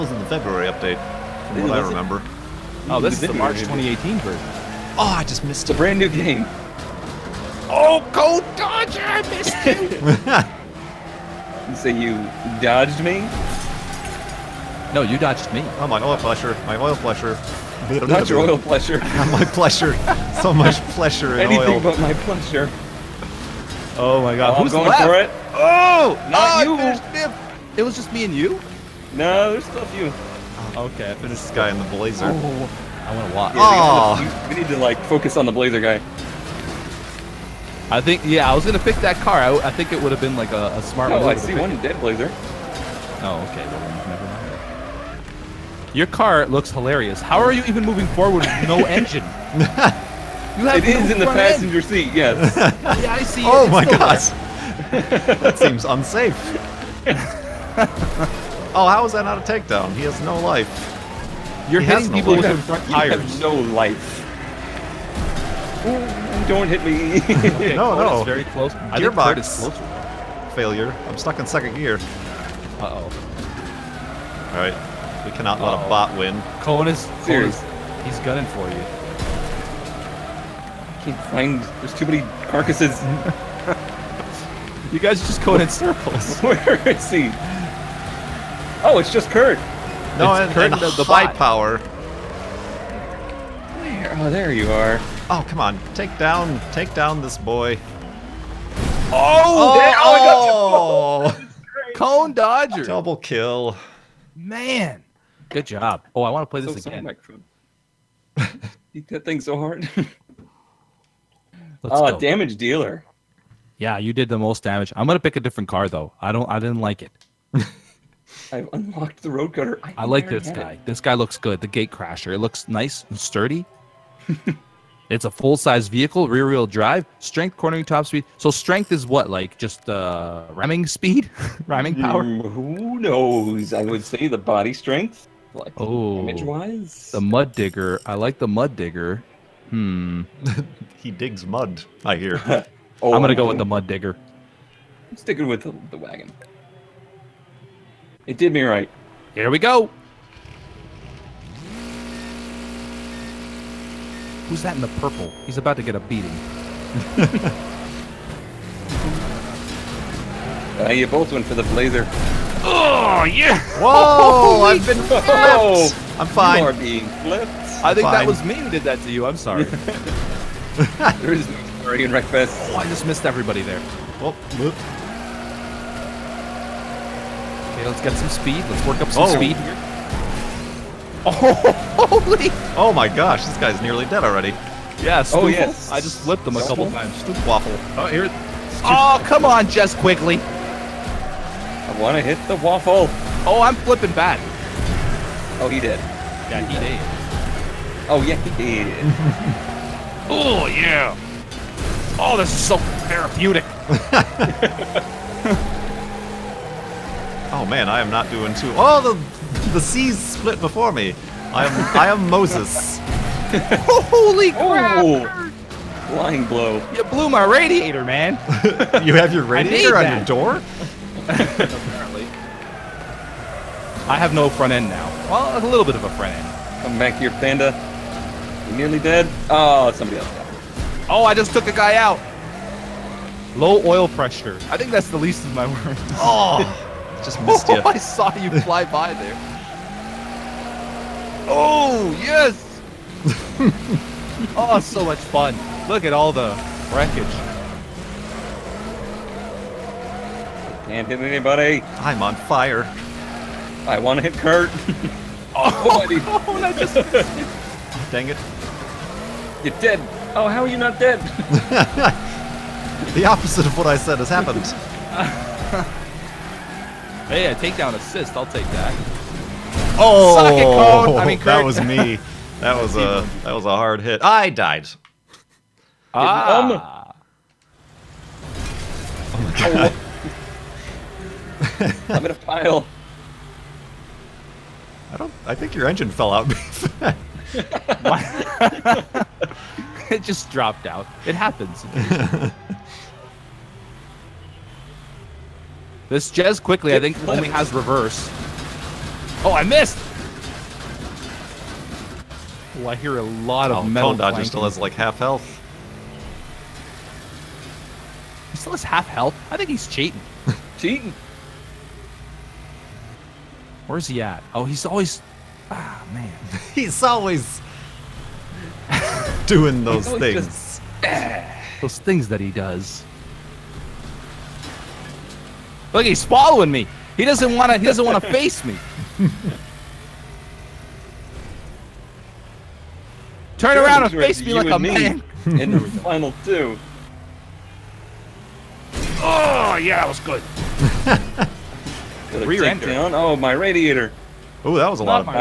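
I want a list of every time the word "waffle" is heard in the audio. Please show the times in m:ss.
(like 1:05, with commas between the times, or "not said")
3:07, 3:12.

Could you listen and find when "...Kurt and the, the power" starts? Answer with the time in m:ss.
1:30.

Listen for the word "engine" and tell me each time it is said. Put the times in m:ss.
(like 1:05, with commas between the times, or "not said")
0:48, 4:45.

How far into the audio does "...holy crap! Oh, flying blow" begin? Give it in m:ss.
3:34.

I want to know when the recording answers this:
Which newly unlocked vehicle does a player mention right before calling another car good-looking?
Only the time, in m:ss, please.
1:59.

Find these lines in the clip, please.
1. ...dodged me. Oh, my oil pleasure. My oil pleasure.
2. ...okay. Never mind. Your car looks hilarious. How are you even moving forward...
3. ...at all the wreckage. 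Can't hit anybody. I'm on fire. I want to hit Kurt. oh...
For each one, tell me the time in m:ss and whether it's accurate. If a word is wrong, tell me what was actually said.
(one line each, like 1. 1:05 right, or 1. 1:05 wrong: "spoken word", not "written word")
1. 0:15 right
2. 0:43 right
3. 4:06 right.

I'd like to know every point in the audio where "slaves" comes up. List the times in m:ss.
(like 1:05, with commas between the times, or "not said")
not said.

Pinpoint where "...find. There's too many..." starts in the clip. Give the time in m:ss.
1:21.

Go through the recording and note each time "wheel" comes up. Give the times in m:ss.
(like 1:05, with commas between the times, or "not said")
2:06.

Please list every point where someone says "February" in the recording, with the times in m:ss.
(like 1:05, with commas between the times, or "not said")
0:00.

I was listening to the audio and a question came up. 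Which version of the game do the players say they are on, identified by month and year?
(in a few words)
March 2018.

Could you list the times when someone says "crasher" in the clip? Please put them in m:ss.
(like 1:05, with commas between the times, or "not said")
2:01.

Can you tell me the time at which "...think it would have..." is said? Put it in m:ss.
0:39.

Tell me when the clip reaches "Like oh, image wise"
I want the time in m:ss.
2:15.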